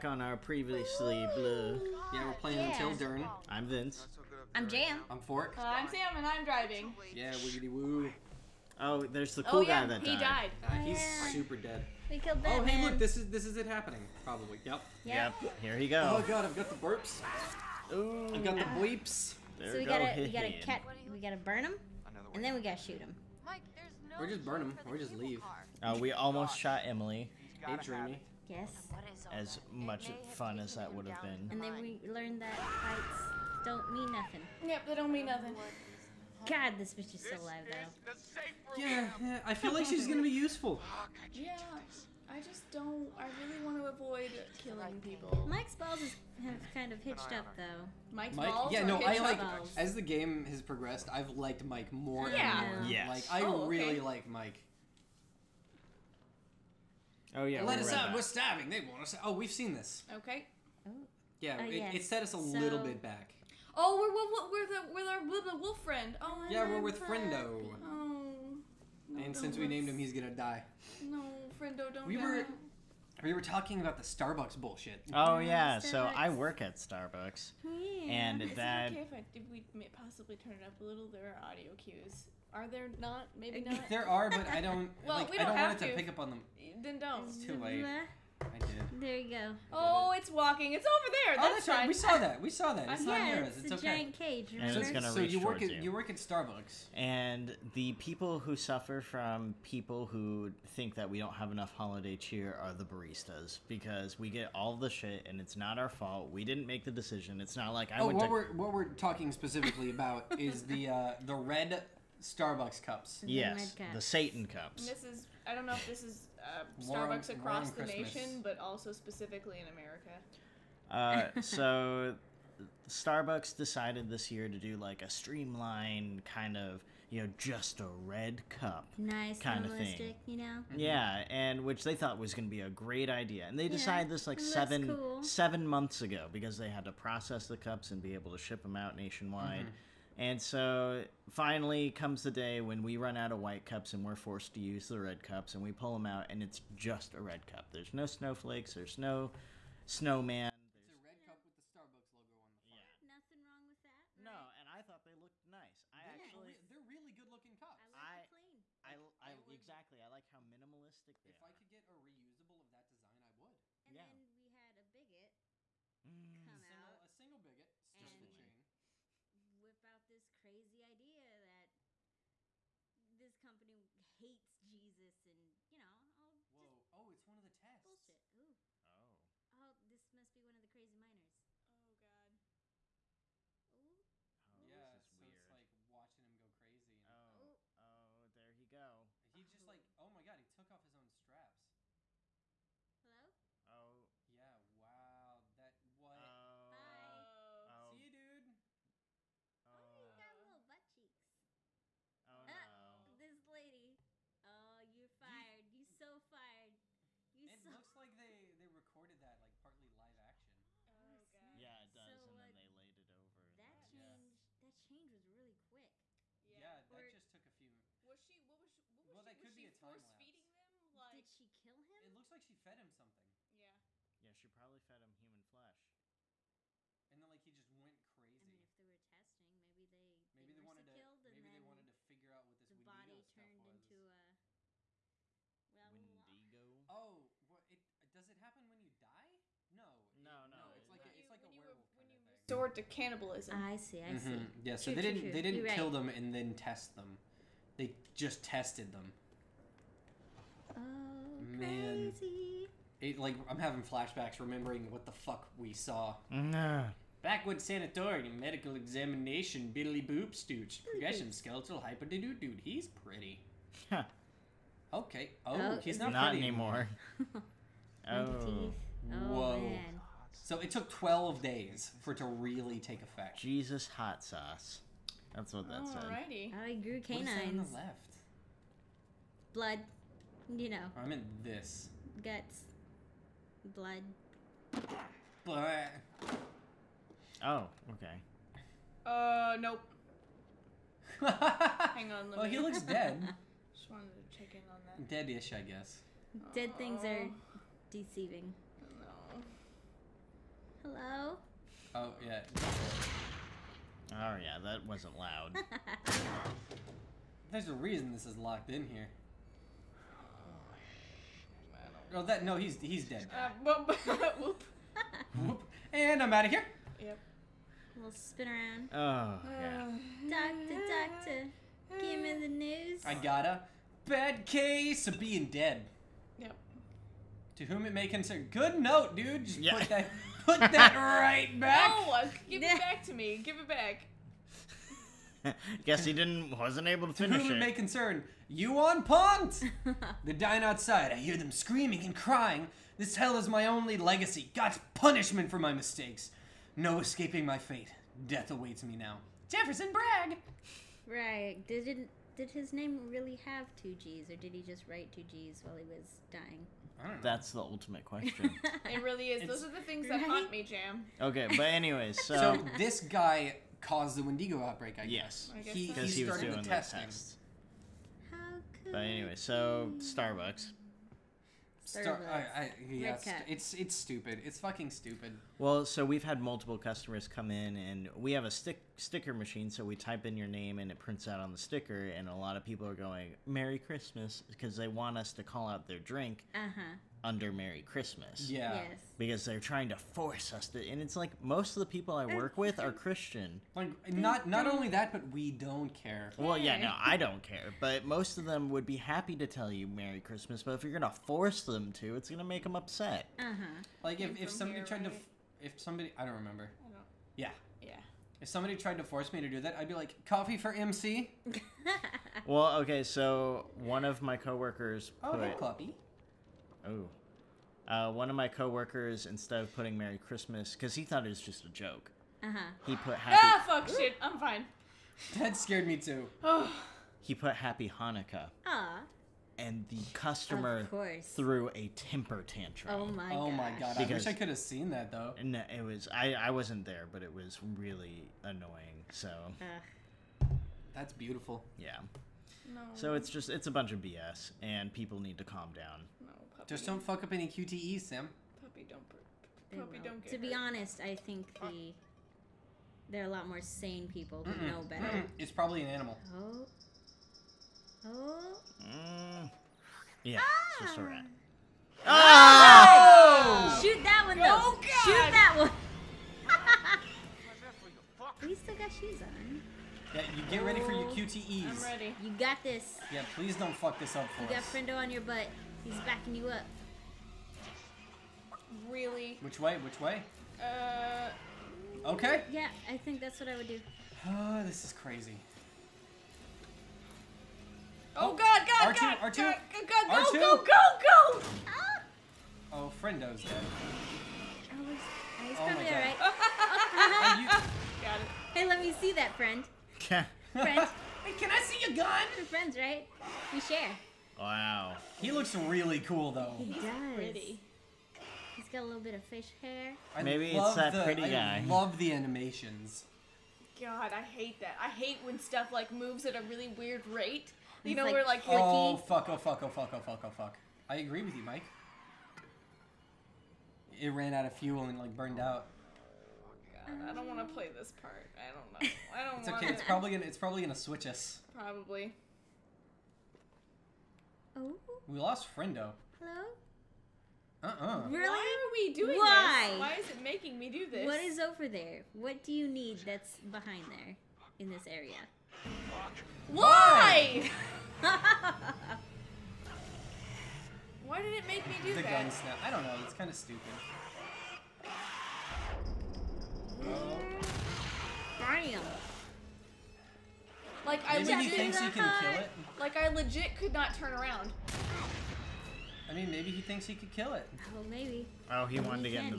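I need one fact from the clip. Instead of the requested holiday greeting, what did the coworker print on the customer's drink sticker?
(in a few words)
Happy Hanukkah.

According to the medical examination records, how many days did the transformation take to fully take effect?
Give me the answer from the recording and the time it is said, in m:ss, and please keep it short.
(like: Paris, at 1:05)
12, at 4:30.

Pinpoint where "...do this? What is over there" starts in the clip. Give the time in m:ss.
9:00.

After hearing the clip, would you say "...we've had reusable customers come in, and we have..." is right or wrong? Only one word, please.
wrong.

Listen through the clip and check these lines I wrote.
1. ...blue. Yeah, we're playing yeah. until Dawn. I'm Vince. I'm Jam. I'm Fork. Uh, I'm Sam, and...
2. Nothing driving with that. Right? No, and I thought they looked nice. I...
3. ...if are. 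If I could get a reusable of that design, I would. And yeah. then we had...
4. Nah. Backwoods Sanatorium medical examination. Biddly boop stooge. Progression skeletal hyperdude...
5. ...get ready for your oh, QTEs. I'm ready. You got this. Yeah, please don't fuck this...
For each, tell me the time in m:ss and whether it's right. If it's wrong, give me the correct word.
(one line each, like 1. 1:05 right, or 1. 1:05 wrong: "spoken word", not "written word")
1. 0:01 right
2. 2:33 wrong: "wrong", not "driving"
3. 2:41 right
4. 4:16 right
5. 7:50 right.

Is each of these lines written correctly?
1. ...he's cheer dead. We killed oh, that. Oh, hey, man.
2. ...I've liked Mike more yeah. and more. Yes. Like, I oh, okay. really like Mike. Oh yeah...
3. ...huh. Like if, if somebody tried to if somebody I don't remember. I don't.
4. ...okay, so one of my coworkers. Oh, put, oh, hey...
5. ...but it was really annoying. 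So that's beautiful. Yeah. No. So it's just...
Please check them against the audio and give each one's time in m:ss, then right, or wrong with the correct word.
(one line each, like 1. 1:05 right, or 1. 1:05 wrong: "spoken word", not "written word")
1. 0:10 wrong: "super", not "cheer"
2. 0:51 right
3. 6:43 right
4. 6:52 right
5. 7:17 right.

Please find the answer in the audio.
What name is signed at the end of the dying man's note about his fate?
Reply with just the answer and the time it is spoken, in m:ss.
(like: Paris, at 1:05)
Jefferson Bragg, at 5:49.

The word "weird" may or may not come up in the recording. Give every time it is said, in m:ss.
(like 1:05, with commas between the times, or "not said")
3:05, 8:36.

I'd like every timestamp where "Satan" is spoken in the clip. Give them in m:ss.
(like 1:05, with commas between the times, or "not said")
1:54.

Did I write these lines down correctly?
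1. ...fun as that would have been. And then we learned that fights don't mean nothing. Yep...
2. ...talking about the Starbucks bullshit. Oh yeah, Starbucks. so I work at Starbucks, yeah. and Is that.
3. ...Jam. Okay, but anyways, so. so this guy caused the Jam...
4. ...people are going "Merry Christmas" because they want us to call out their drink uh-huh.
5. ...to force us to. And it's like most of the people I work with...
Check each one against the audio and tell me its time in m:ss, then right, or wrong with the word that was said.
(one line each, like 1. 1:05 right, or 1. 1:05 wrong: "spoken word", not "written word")
1. 0:30 right
2. 1:13 right
3. 6:00 wrong: "Wendigo", not "Jam"
4. 6:22 right
5. 6:29 right.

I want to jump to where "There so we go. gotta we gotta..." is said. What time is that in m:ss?
0:19.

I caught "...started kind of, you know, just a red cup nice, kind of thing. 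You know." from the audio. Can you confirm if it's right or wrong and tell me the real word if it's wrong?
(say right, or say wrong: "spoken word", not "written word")
wrong: "streamlined", not "started".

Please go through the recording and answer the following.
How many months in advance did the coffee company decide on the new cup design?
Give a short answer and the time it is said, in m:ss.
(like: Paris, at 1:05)
7, at 2:15.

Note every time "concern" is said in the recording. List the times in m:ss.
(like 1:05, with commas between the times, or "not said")
5:28, 5:37.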